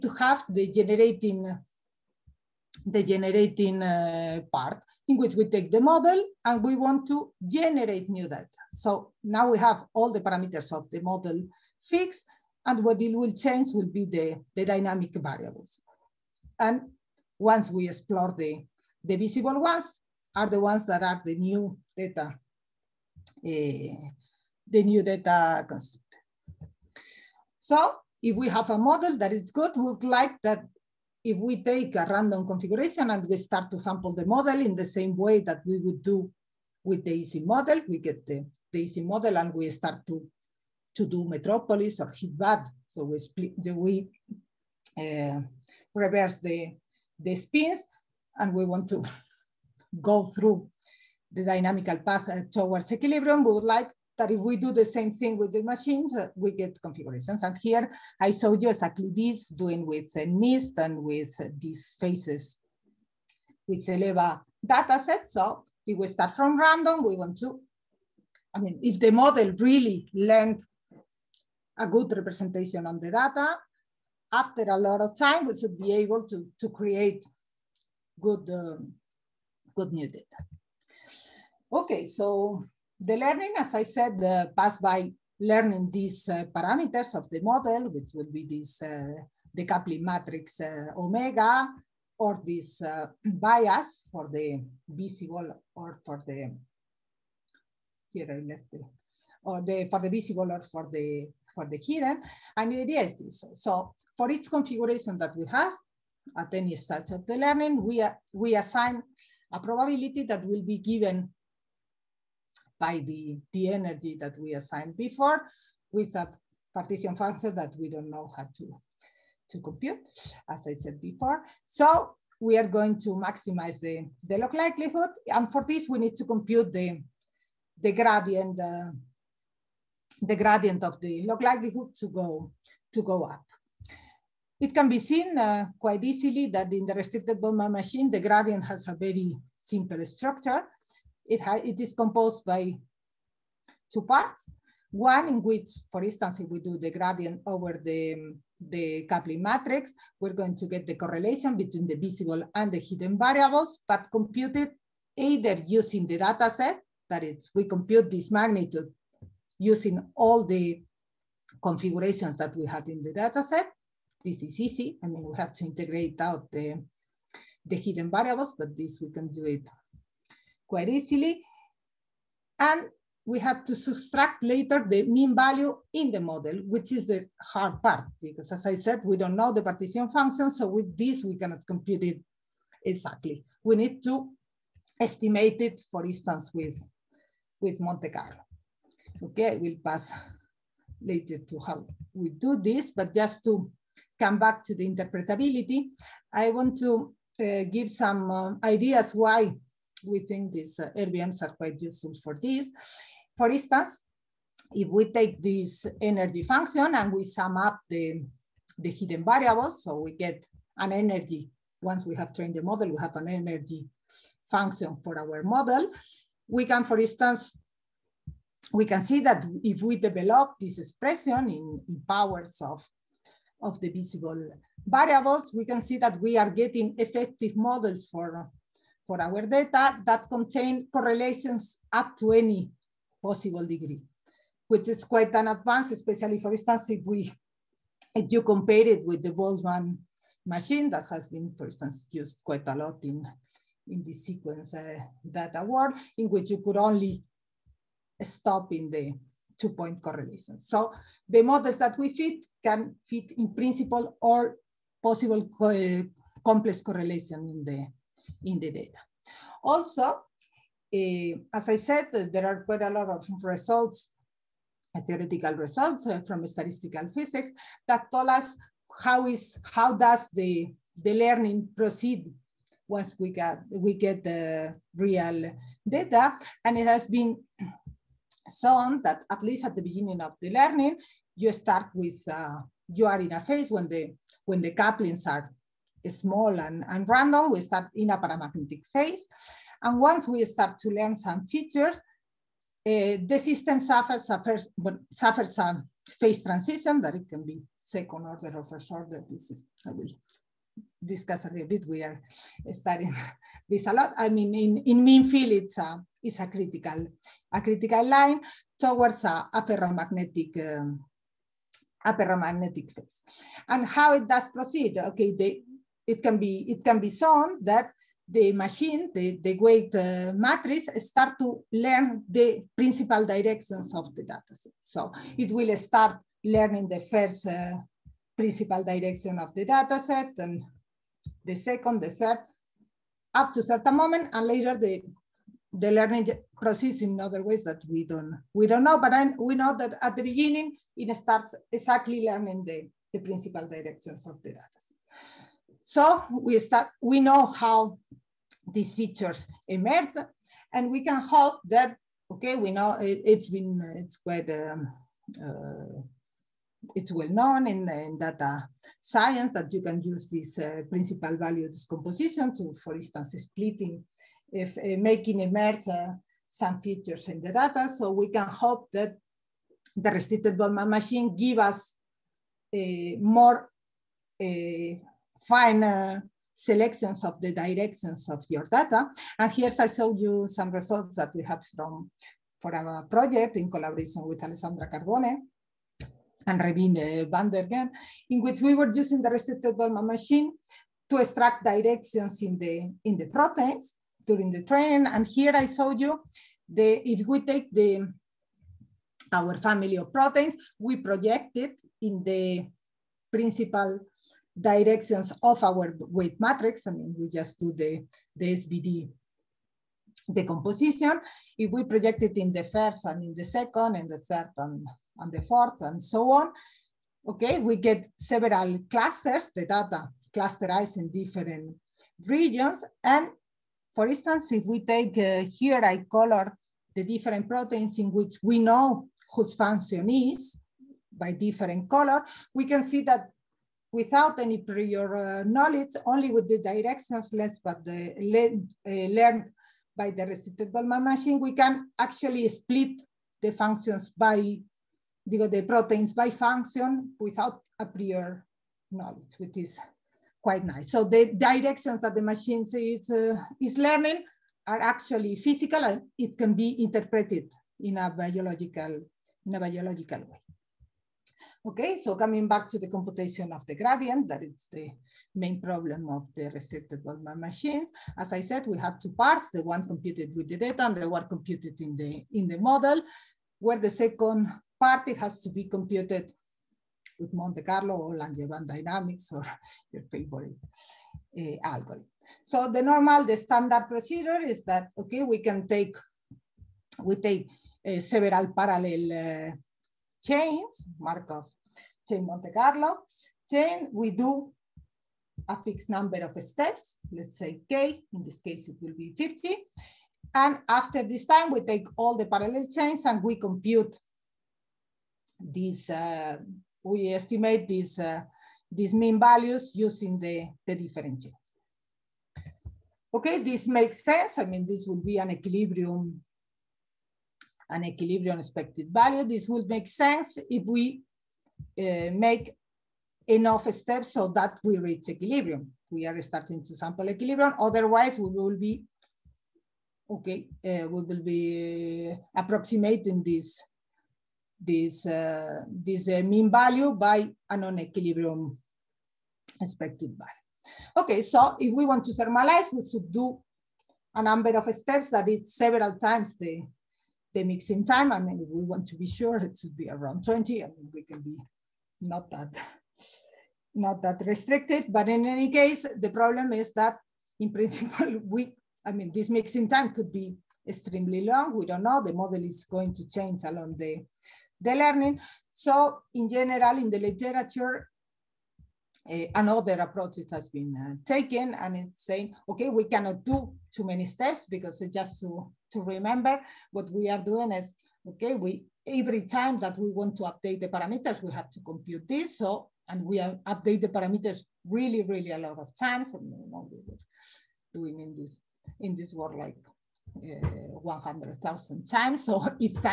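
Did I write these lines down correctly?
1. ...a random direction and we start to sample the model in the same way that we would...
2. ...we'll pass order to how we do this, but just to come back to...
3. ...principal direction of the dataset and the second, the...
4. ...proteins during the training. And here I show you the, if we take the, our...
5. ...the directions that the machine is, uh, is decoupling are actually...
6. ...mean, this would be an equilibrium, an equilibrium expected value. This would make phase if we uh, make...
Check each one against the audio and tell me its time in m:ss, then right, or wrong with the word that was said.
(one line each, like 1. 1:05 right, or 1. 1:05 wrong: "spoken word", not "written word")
1. 0:31 wrong: "configuration", not "direction"
2. 3:09 wrong: "later", not "order"
3. 5:28 right
4. 6:33 right
5. 7:31 wrong: "learning", not "decoupling"
6. 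8:34 wrong: "sense", not "phase".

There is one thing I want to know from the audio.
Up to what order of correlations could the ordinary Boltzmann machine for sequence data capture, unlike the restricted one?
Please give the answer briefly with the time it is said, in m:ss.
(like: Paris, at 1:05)
two point correlation, at 4:09.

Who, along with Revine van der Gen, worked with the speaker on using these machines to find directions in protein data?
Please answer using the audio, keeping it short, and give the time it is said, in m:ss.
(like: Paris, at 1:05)
Alessandra Carbone, at 6:24.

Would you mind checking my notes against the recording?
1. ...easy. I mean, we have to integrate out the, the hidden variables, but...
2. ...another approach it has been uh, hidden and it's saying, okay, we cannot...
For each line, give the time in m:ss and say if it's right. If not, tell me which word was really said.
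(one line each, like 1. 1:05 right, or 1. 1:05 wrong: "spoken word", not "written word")
1. 2:44 right
2. 9:29 wrong: "taken", not "hidden".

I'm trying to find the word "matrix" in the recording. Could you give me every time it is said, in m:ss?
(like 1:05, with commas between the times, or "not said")
1:30, 2:29, 5:20, 6:46.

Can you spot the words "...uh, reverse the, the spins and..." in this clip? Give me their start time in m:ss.
0:44.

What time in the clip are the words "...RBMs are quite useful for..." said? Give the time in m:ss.
3:20.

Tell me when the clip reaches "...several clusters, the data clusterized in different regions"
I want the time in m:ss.
6:58.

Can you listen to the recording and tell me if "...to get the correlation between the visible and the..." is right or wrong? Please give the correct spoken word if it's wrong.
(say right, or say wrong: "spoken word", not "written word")
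right.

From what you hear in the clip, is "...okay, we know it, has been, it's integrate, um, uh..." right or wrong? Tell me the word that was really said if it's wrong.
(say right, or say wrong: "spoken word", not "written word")
wrong: "quite", not "integrate".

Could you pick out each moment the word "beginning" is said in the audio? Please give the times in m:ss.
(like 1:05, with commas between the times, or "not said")
4:39, 5:40.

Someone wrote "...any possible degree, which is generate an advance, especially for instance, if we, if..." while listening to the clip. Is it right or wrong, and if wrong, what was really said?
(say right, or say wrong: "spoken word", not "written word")
wrong: "quite", not "generate".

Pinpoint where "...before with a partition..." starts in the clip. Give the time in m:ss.
1:55.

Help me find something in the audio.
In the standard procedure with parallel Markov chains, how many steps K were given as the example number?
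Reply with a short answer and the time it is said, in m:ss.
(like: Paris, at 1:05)
50, at 8:19.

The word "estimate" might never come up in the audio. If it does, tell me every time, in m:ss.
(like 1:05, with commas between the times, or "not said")
3:05, 8:27.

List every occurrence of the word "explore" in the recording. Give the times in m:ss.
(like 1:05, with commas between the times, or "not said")
0:17.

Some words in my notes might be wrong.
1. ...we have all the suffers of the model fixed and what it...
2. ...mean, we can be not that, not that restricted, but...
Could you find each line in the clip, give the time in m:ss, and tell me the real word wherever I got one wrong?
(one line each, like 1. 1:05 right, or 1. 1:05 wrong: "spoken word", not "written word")
1. 0:09 wrong: "parameters", not "suffers"
2. 9:10 right.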